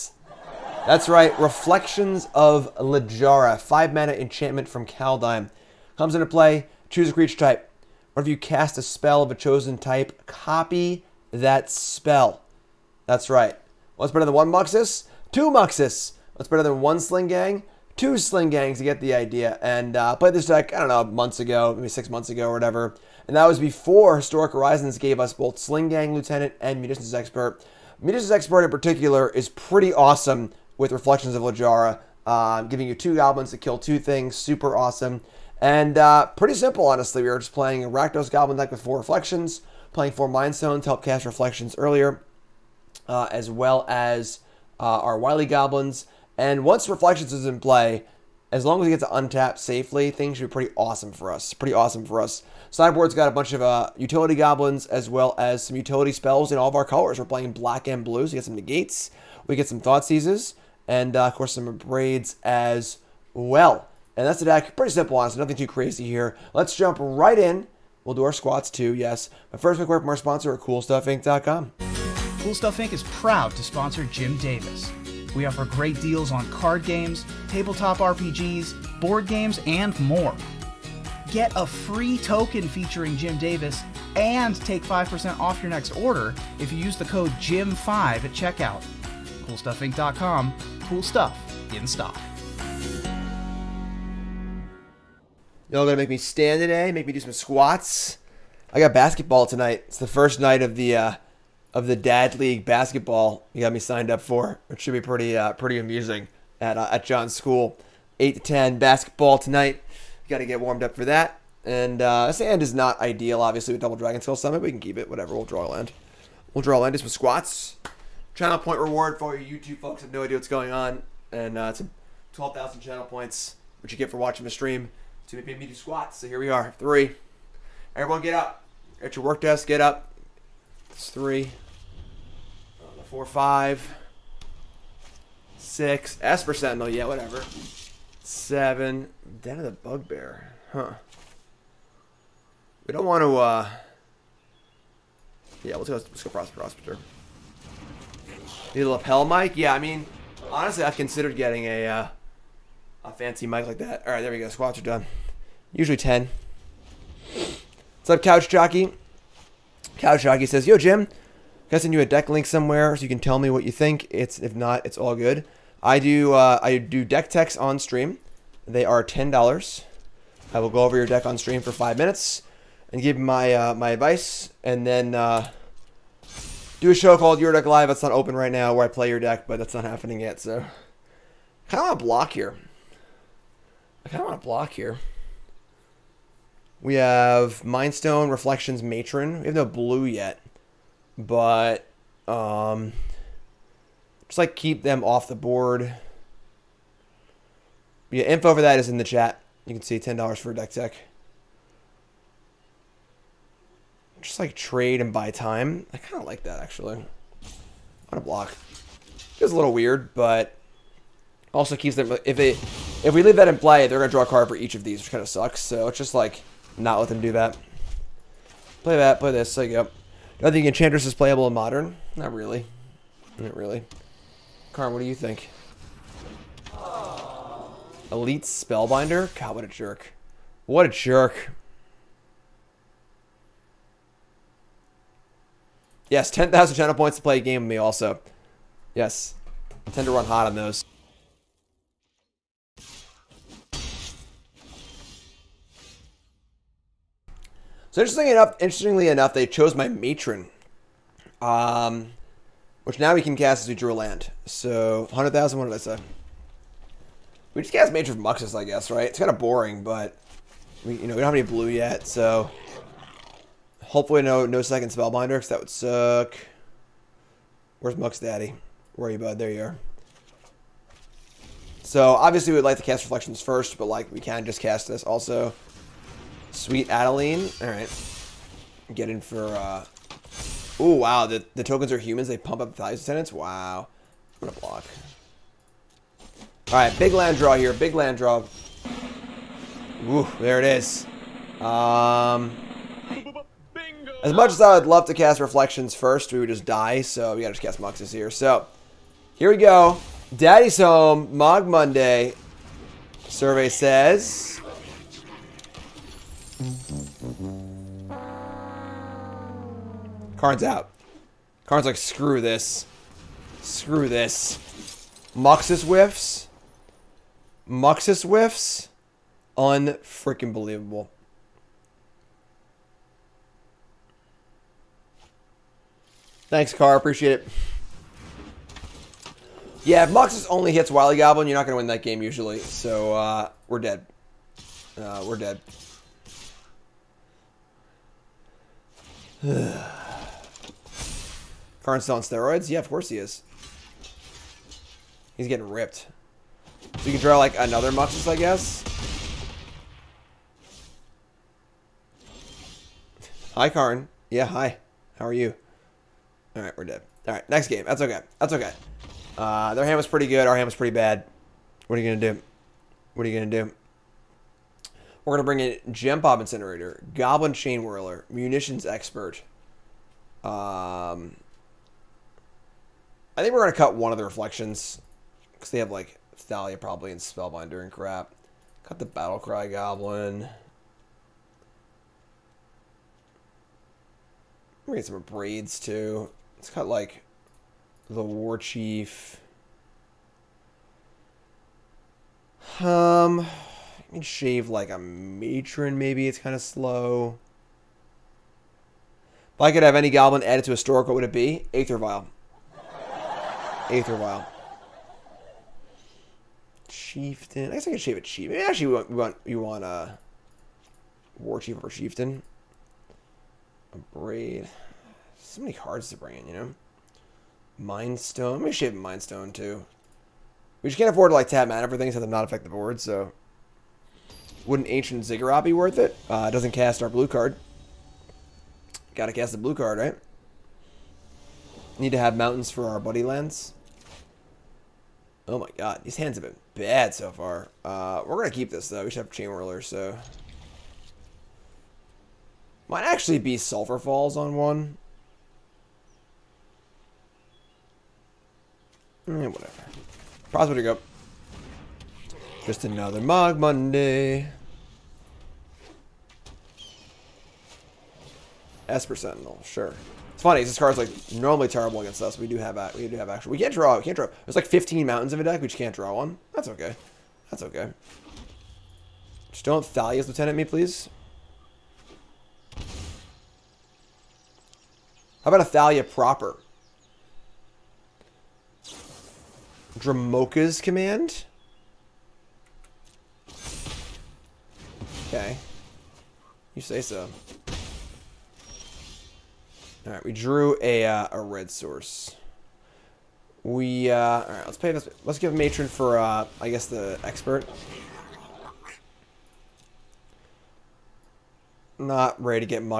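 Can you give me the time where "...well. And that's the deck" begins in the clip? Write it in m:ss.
1:03.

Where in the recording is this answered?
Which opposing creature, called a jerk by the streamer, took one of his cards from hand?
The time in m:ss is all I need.
3:48.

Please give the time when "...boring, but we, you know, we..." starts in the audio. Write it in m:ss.
4:19.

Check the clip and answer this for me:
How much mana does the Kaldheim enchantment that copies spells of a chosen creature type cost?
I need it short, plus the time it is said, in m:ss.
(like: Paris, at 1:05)
5, at 0:03.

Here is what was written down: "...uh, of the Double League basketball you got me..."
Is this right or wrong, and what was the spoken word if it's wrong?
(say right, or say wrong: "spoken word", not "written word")
wrong: "Dad", not "Double".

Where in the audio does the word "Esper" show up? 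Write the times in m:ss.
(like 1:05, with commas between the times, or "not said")
2:16, 7:38.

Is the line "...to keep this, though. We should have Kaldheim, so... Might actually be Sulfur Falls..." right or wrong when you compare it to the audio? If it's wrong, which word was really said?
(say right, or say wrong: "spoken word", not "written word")
wrong: "Chainwhirler", not "Kaldheim".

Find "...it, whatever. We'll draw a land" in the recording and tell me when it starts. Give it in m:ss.
1:54.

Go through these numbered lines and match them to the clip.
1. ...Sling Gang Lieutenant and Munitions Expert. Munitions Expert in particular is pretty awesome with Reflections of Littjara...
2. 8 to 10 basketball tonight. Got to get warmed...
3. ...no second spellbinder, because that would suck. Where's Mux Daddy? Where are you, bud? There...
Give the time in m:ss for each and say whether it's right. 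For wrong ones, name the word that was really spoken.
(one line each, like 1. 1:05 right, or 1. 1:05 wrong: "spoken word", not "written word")
1. 0:25 right
2. 1:48 right
3. 4:24 right.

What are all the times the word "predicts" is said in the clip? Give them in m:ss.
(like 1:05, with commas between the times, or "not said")
not said.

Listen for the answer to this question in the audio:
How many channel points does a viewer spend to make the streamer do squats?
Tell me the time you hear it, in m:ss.
2:02.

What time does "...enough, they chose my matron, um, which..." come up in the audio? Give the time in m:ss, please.
4:09.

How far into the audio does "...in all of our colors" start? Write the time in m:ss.
0:56.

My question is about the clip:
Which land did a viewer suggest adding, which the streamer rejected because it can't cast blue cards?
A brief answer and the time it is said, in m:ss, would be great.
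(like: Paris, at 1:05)
Ancient Ziggurat, at 7:04.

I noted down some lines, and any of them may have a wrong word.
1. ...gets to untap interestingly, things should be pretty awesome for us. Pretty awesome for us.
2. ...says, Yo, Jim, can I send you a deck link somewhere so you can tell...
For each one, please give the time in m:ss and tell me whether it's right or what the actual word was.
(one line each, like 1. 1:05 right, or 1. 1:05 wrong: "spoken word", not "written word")
1. 0:48 wrong: "safely", not "interestingly"
2. 2:40 right.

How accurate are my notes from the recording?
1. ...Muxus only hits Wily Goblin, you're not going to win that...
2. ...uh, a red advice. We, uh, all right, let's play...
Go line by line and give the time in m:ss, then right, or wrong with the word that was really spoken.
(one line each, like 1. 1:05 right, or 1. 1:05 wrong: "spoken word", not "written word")
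1. 5:30 right
2. 8:11 wrong: "source", not "advice".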